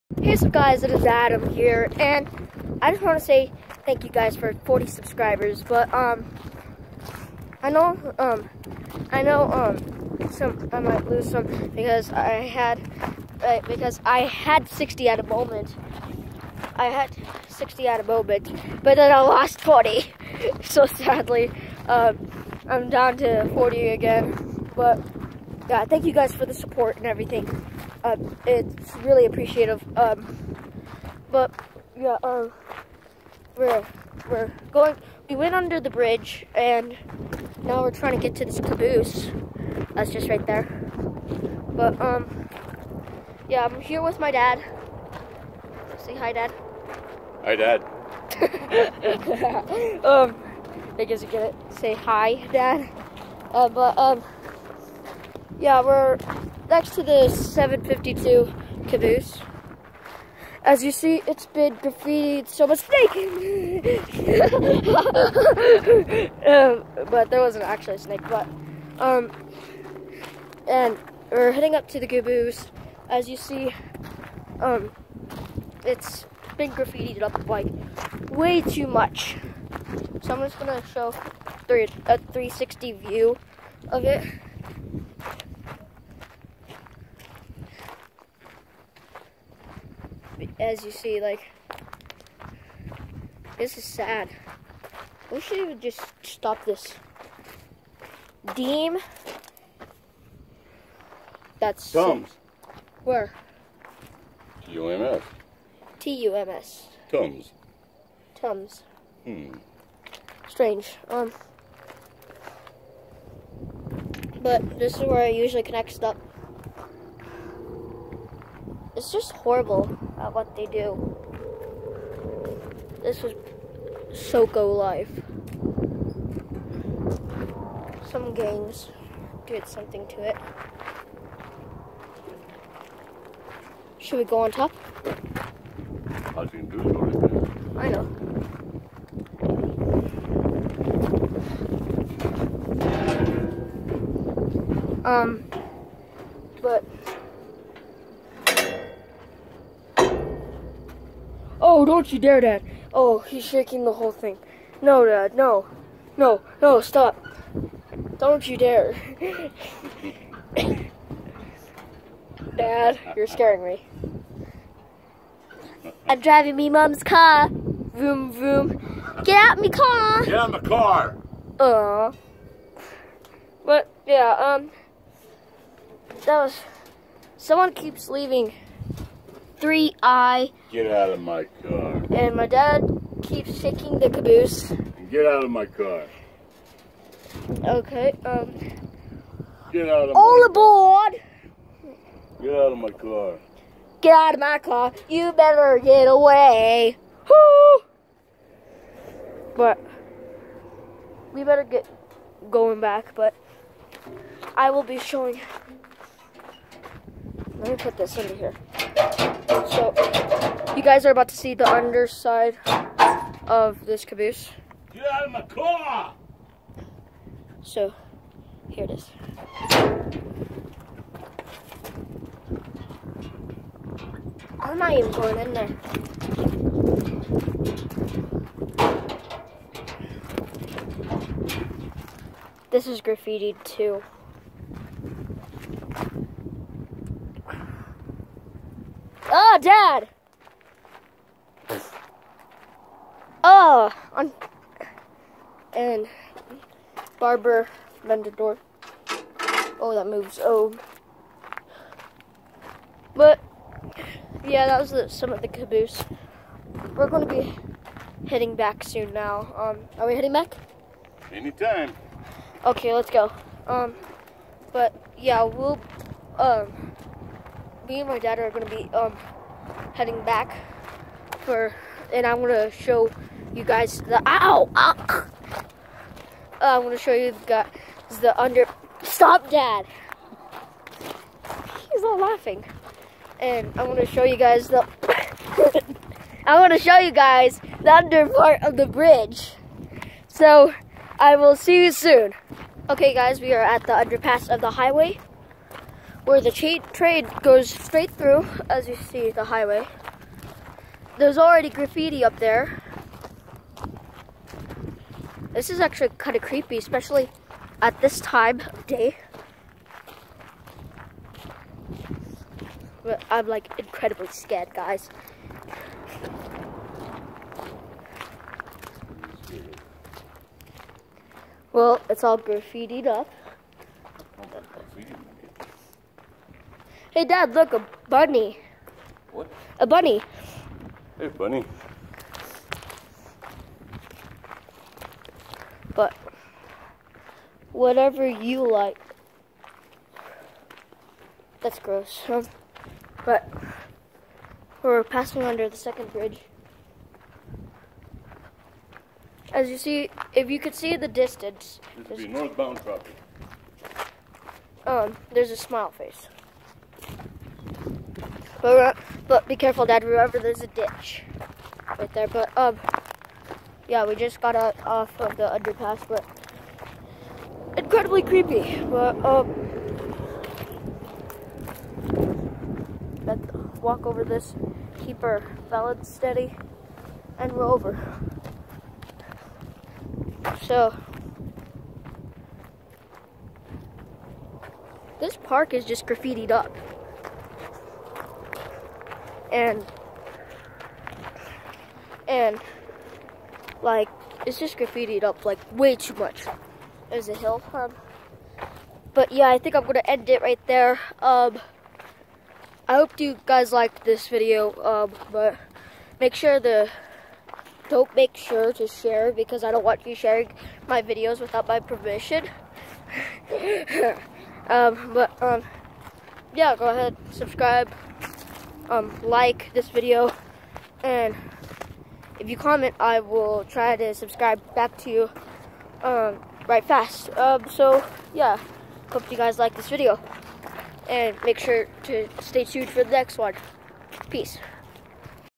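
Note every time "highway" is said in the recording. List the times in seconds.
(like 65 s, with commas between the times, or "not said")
294 s, 299 s.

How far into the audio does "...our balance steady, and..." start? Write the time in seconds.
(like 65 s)
375 s.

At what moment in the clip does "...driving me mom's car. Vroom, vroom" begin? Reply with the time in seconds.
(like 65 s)
166 s.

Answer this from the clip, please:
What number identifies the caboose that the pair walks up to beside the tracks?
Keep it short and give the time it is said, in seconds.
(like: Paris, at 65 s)
752, at 57 s.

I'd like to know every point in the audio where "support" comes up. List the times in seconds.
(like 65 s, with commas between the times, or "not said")
26 s.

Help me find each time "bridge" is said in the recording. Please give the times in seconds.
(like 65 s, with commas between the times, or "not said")
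35 s, 288 s, 346 s.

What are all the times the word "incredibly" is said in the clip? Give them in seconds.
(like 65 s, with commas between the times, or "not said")
313 s, 367 s.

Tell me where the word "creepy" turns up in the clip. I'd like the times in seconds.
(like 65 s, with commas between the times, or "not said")
306 s, 368 s.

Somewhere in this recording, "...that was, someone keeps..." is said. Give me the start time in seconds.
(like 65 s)
176 s.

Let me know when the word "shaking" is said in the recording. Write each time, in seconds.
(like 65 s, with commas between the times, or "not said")
153 s, 183 s.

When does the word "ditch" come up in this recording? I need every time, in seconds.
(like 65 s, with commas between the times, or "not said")
360 s.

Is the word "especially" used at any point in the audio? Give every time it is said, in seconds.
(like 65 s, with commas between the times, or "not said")
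306 s.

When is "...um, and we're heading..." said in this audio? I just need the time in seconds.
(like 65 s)
68 s.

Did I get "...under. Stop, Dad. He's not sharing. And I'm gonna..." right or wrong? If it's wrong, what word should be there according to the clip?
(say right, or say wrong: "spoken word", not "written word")
wrong: "laughing", not "sharing".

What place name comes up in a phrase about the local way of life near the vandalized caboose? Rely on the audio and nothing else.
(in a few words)
Soco.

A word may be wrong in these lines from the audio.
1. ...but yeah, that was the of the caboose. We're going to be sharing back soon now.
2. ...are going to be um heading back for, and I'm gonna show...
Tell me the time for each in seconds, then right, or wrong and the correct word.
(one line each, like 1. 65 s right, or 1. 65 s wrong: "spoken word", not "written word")
1. 253 s wrong: "heading", not "sharing"
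2. 268 s right.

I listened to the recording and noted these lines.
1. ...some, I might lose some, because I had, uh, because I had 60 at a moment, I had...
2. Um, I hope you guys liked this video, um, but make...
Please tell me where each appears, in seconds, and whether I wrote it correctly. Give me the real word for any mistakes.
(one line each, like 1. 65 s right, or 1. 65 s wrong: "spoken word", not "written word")
1. 10 s right
2. 401 s right.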